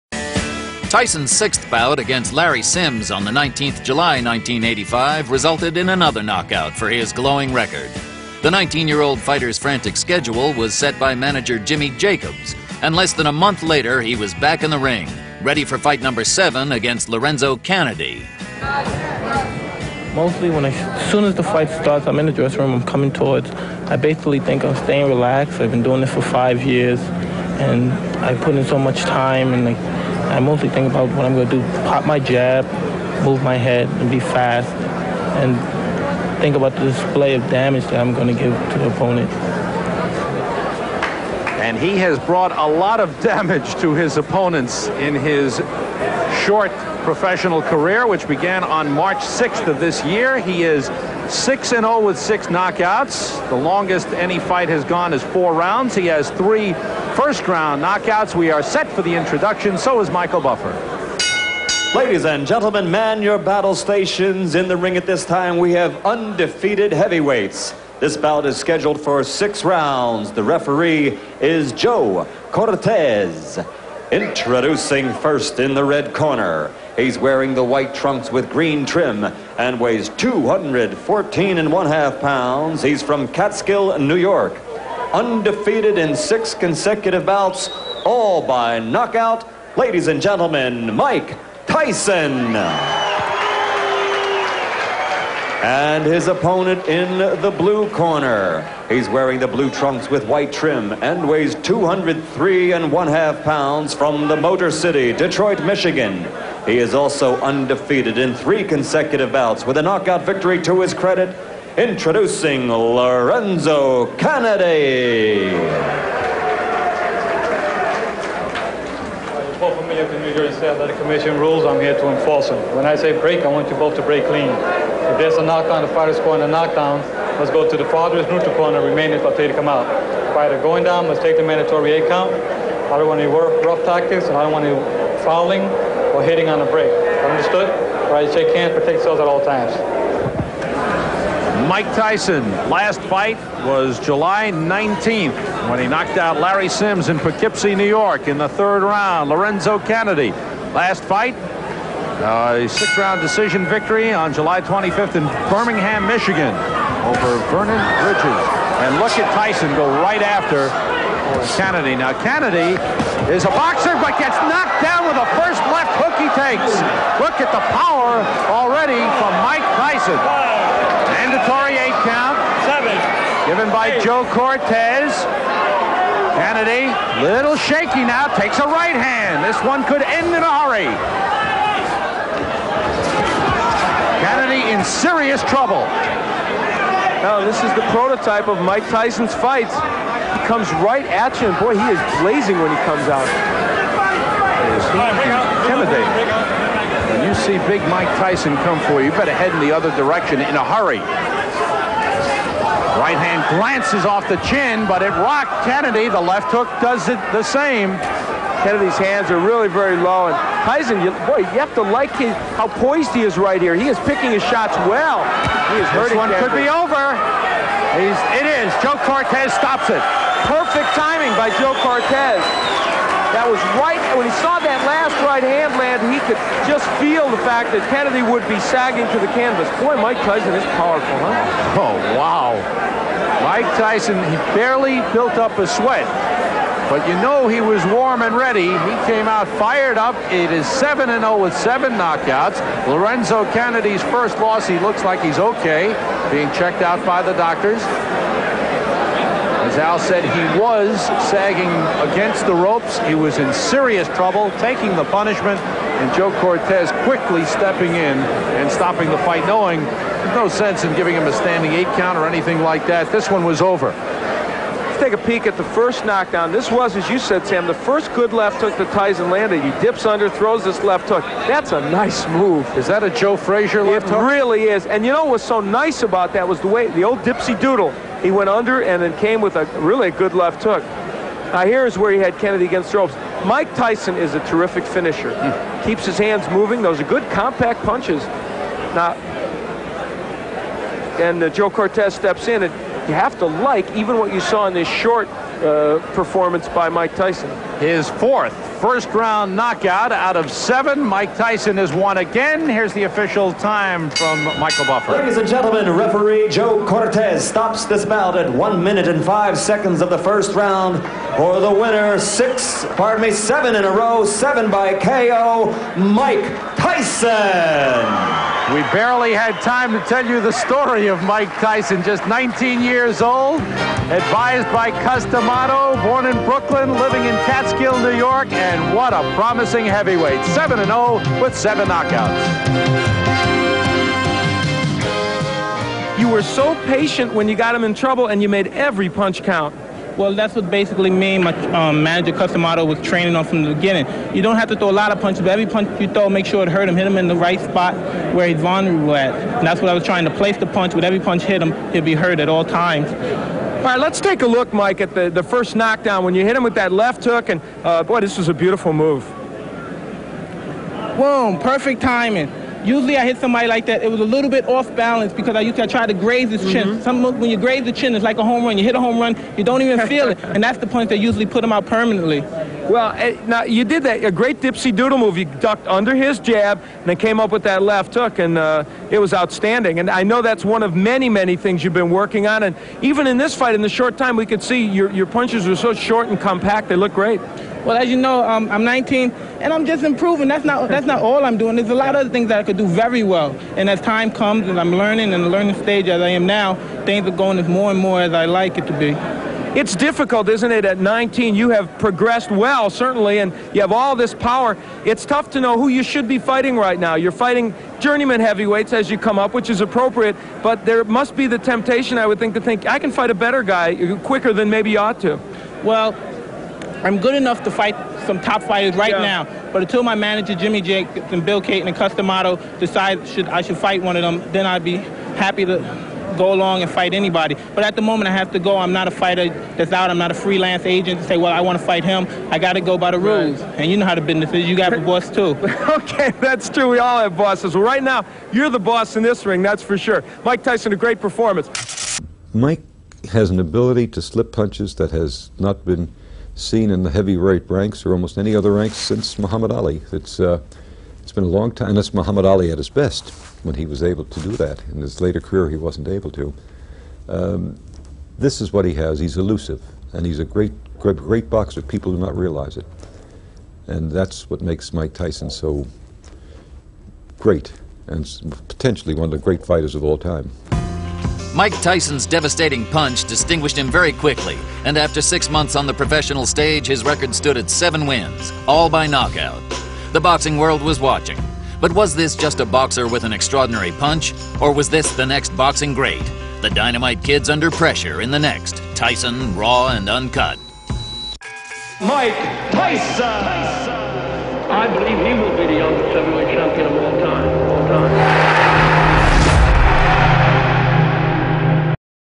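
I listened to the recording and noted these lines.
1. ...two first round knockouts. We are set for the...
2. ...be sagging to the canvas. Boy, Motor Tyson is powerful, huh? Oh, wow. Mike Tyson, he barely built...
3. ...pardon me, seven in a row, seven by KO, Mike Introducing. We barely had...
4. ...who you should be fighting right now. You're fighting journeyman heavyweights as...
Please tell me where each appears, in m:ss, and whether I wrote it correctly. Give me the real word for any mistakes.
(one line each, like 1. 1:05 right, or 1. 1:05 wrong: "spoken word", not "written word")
1. 0:56 wrong: "three", not "two"
2. 3:48 wrong: "Mike", not "Motor"
3. 5:12 wrong: "Tyson", not "Introducing"
4. 6:45 right.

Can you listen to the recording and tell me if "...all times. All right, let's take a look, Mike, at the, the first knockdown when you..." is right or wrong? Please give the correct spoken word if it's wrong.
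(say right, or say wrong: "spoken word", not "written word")
right.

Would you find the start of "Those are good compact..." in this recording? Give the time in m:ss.
4:46.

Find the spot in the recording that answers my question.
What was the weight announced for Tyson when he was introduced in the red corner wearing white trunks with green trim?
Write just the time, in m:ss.
1:20.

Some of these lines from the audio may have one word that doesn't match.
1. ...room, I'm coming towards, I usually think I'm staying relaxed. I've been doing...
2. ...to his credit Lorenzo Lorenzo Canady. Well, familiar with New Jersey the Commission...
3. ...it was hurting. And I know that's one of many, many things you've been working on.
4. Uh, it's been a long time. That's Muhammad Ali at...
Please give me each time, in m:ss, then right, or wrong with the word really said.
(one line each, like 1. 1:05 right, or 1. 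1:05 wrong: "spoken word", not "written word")
1. 0:22 wrong: "basically", not "usually"
2. 1:50 wrong: "Introducing", not "Lorenzo"
3. 6:19 wrong: "outstanding", not "hurting"
4. 7:30 right.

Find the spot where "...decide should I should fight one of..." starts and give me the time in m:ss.
7:02.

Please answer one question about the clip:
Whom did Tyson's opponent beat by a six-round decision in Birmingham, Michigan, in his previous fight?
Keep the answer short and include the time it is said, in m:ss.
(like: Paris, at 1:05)
Vernon Bridges, at 2:37.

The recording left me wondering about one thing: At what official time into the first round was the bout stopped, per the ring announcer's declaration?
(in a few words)
1 minute 5 seconds.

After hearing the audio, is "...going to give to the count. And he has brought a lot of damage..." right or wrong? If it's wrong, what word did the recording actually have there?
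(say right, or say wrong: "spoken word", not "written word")
wrong: "opponent", not "count".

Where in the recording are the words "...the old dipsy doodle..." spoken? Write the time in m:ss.
4:36.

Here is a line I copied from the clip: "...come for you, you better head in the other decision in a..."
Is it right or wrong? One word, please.
wrong.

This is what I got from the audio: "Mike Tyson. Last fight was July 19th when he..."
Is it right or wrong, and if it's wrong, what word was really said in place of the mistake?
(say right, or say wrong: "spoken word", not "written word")
right.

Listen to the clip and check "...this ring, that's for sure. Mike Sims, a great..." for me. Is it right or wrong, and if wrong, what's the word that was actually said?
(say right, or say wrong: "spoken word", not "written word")
wrong: "Tyson", not "Sims".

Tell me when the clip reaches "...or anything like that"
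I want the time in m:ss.
4:22.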